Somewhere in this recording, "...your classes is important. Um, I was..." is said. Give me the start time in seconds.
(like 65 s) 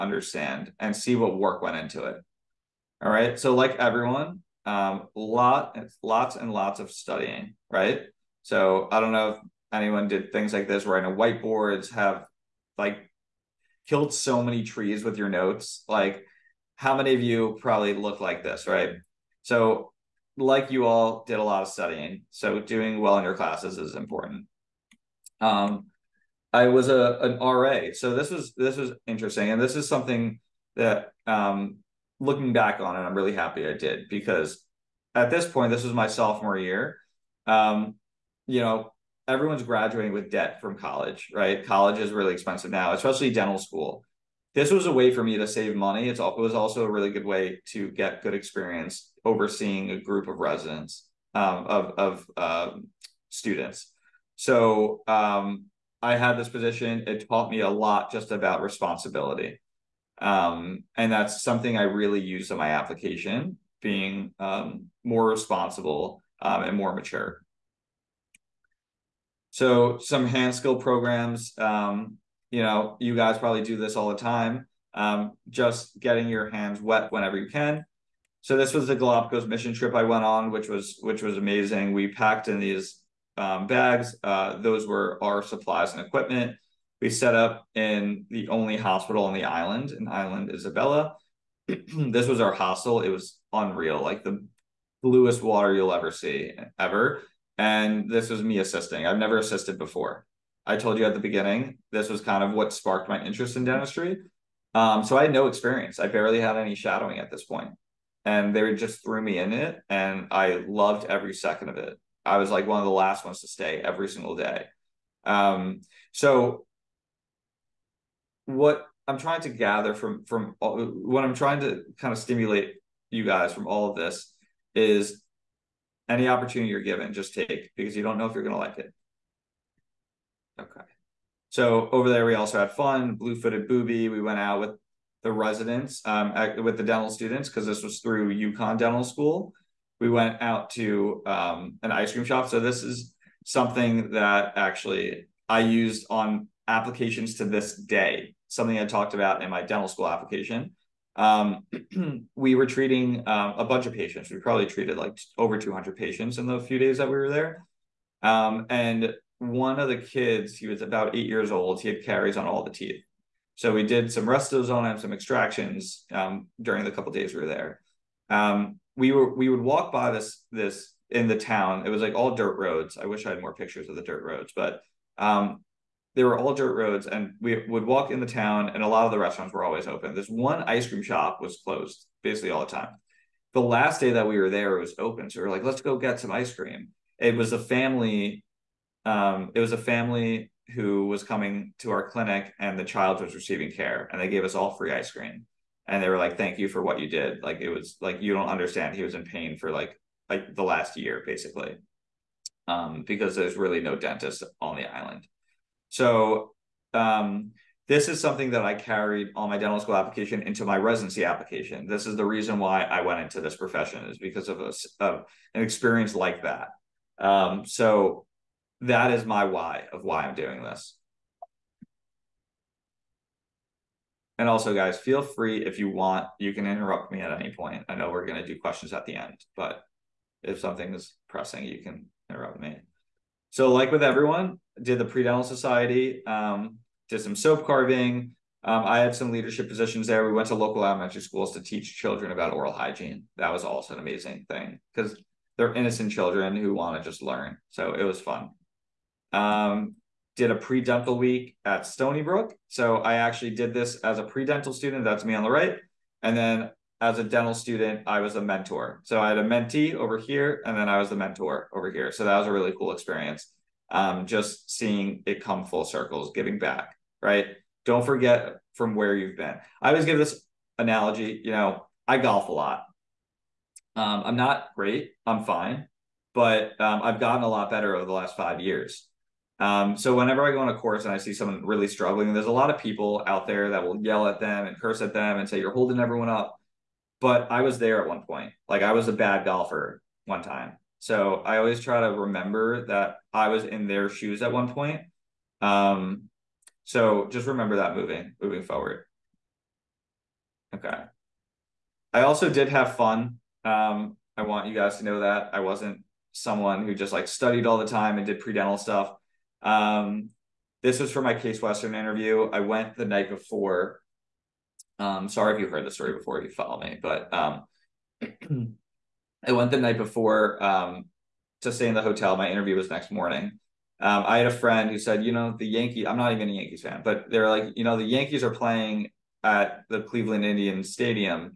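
23 s.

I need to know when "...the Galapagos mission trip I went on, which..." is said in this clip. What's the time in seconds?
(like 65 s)
78 s.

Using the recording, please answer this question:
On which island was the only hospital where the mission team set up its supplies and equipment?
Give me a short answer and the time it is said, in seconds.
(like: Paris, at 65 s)
Isabella, at 90 s.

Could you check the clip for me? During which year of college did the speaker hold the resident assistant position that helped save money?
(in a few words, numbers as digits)
Sophomore year.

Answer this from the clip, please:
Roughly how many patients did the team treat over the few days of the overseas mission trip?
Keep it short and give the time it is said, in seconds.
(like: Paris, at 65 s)
Over 200, at 155 s.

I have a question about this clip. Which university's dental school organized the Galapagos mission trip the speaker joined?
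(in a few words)
UConn.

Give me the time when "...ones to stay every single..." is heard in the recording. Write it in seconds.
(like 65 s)
113 s.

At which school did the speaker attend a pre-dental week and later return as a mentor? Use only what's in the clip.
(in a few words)
Stony Brook.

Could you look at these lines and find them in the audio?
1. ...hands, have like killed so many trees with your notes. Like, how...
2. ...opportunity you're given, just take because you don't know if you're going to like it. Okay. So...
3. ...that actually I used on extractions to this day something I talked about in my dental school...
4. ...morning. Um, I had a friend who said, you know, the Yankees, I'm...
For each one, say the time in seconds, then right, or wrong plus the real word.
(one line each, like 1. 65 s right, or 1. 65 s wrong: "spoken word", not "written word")
1. 11 s wrong: "whiteboards", not "hands"
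2. 126 s right
3. 144 s wrong: "applications", not "extractions"
4. 323 s right.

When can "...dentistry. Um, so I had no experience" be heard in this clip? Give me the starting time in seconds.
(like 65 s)
103 s.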